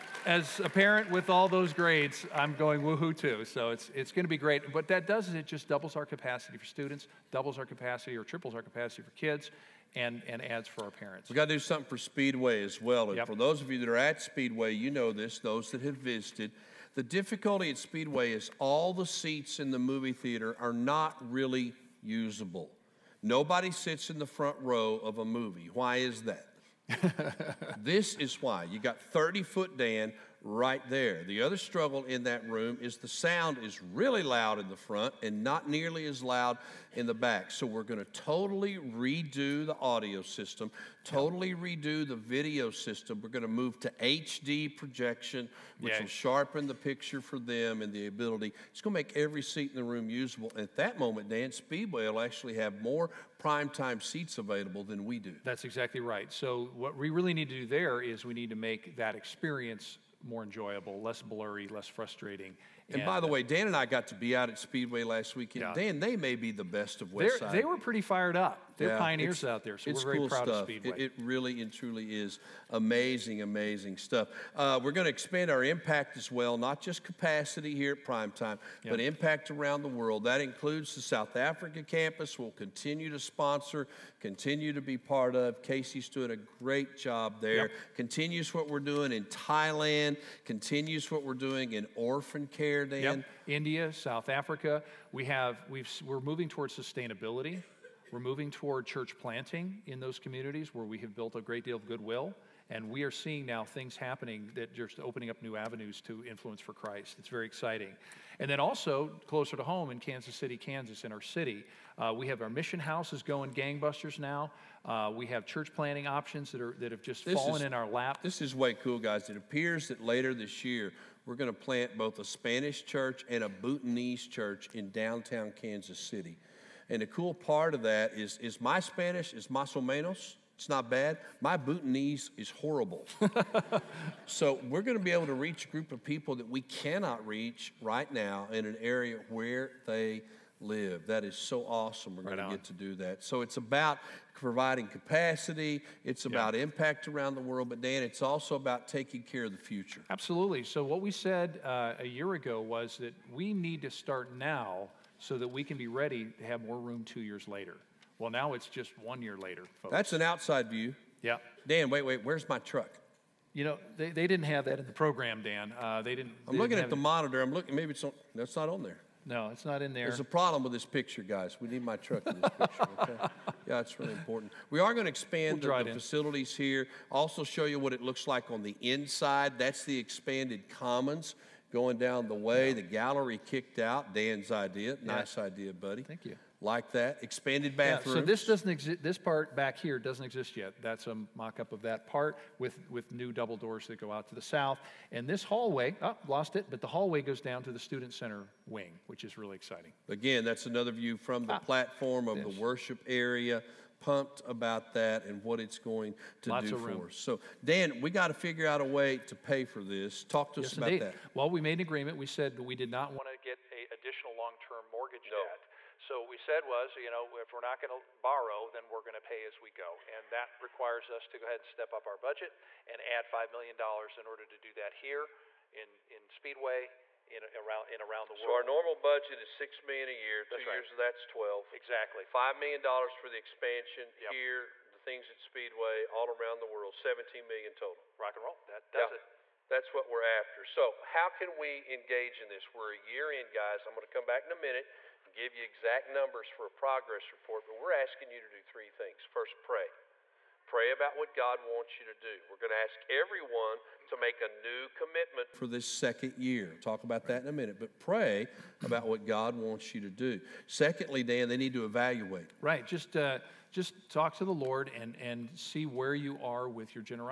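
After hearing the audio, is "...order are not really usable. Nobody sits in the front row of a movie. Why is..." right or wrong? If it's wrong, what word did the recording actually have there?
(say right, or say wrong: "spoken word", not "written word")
wrong: "theater", not "order".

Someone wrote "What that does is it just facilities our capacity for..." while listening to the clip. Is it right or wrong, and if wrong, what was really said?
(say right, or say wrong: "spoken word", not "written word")
wrong: "doubles", not "facilities".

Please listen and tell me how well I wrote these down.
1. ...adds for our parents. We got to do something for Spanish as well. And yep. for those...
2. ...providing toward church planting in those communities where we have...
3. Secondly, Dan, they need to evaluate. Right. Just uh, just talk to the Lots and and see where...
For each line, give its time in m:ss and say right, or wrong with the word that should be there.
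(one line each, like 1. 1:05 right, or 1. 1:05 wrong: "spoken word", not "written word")
1. 0:10 wrong: "Speedway", not "Spanish"
2. 1:38 wrong: "moving", not "providing"
3. 4:20 wrong: "Lord", not "Lots".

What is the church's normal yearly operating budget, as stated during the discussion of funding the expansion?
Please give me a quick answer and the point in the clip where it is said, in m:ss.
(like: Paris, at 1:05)
$6 million, at 3:49.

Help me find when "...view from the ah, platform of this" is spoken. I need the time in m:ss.
3:20.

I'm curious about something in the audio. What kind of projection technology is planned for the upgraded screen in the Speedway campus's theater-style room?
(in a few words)
HD projection.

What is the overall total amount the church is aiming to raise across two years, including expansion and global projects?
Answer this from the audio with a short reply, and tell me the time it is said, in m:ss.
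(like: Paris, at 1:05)
$17 million, at 3:56.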